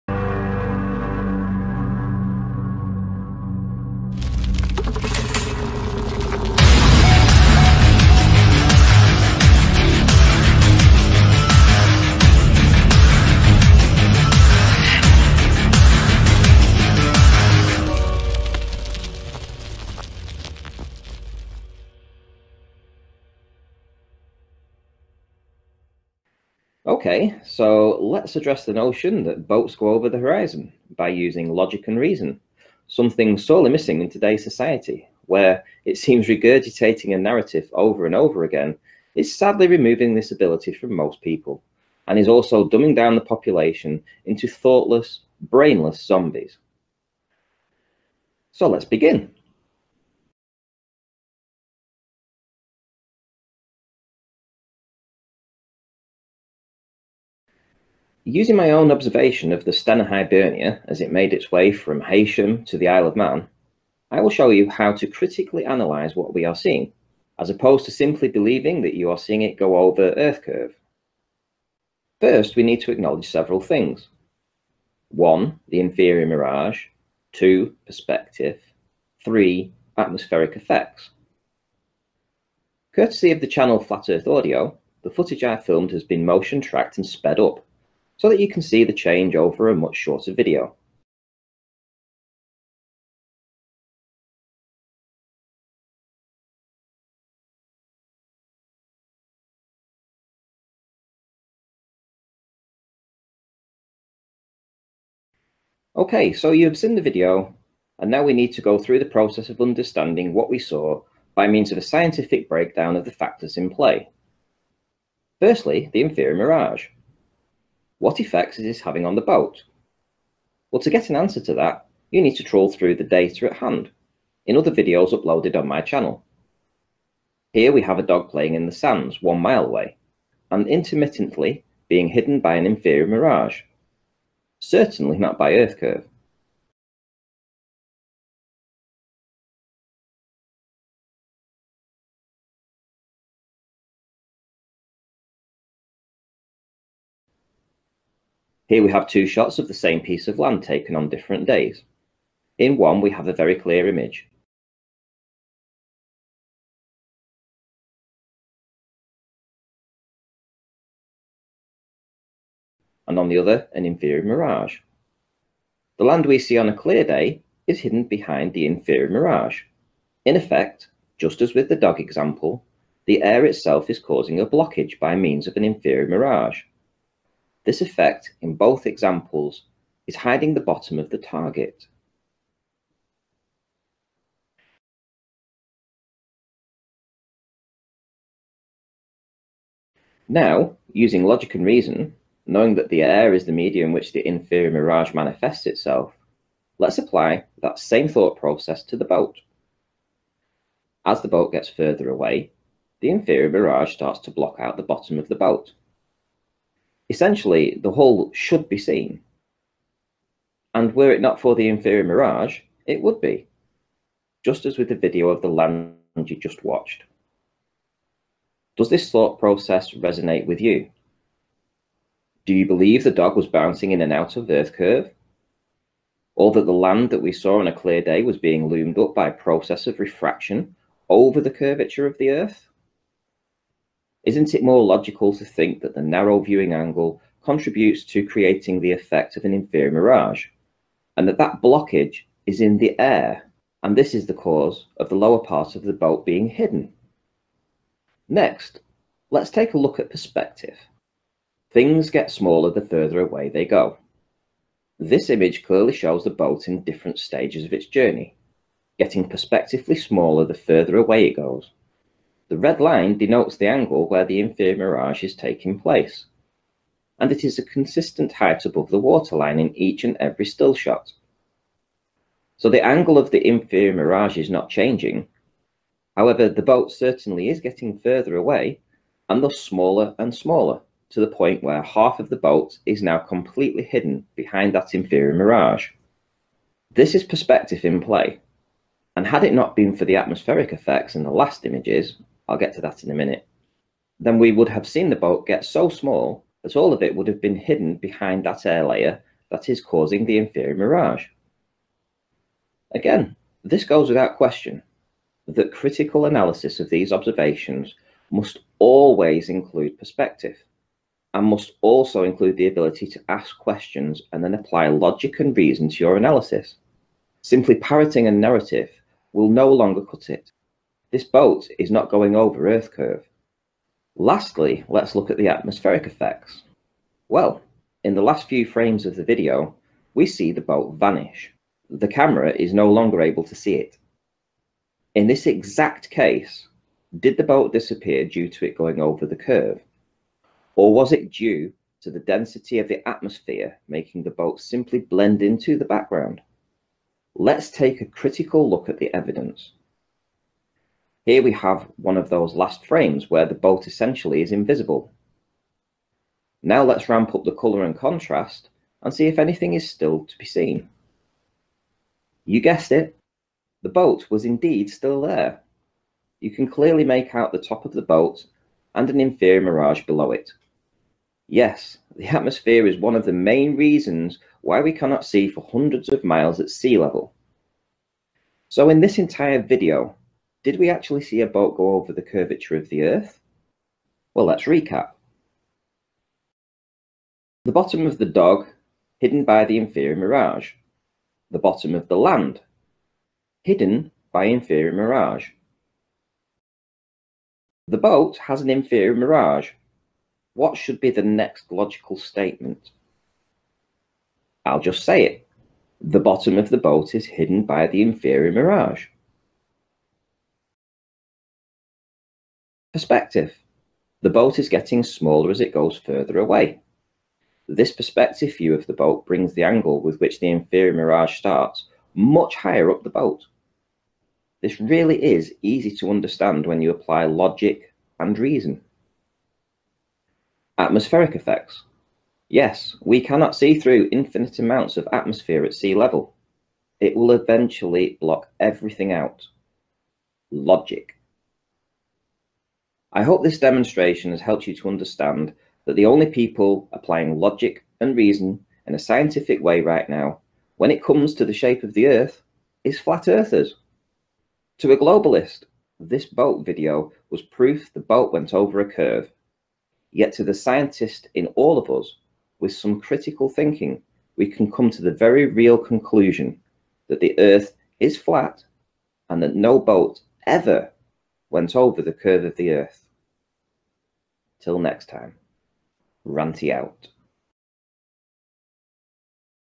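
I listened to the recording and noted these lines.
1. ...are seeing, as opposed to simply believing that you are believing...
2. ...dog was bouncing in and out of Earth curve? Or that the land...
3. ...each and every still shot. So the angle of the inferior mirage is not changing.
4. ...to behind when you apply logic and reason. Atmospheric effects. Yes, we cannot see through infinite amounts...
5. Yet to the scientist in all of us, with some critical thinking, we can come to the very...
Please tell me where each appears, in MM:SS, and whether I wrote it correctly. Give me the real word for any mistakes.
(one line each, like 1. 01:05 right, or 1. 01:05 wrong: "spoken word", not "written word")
1. 01:06 wrong: "seeing", not "believing"
2. 03:43 right
3. 04:29 right
4. 07:05 wrong: "understand", not "behind"
5. 07:40 right.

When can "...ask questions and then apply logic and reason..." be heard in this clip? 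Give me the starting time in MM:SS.
05:13.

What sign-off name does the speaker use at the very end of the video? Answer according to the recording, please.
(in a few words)
Ranty.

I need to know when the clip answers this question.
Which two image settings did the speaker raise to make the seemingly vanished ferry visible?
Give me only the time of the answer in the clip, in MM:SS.
05:57.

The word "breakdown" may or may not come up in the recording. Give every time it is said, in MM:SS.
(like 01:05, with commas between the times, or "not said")
01:52.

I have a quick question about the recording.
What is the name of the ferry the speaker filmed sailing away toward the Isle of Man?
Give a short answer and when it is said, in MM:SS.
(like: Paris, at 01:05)
Stena Hibernia, at 00:59.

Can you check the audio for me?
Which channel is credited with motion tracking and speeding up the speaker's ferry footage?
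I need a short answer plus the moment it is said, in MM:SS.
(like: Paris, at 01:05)
Flat Earth Audio, at 01:23.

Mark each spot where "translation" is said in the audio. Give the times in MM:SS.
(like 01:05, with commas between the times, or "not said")
not said.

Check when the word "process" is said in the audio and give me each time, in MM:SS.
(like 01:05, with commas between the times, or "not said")
01:49, 03:18, 03:39, 03:49.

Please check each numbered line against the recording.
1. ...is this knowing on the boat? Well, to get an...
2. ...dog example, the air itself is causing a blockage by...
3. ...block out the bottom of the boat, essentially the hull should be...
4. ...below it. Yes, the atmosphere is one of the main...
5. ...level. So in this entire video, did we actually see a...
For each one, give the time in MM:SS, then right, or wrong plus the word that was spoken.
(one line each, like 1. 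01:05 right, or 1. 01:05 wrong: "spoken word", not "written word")
1. 01:58 wrong: "having", not "knowing"
2. 02:51 right
3. 03:24 right
4. 06:10 right
5. 06:16 right.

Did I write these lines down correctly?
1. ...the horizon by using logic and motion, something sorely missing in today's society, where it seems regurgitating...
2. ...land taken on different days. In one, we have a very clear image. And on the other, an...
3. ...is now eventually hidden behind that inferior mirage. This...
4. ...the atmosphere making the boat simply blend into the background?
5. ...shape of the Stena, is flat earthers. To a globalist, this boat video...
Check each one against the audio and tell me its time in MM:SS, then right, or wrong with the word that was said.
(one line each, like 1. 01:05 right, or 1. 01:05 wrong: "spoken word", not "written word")
1. 00:30 wrong: "reason", not "motion"
2. 02:30 right
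3. 04:42 wrong: "completely", not "eventually"
4. 05:42 right
5. 07:31 wrong: "Earth", not "Stena".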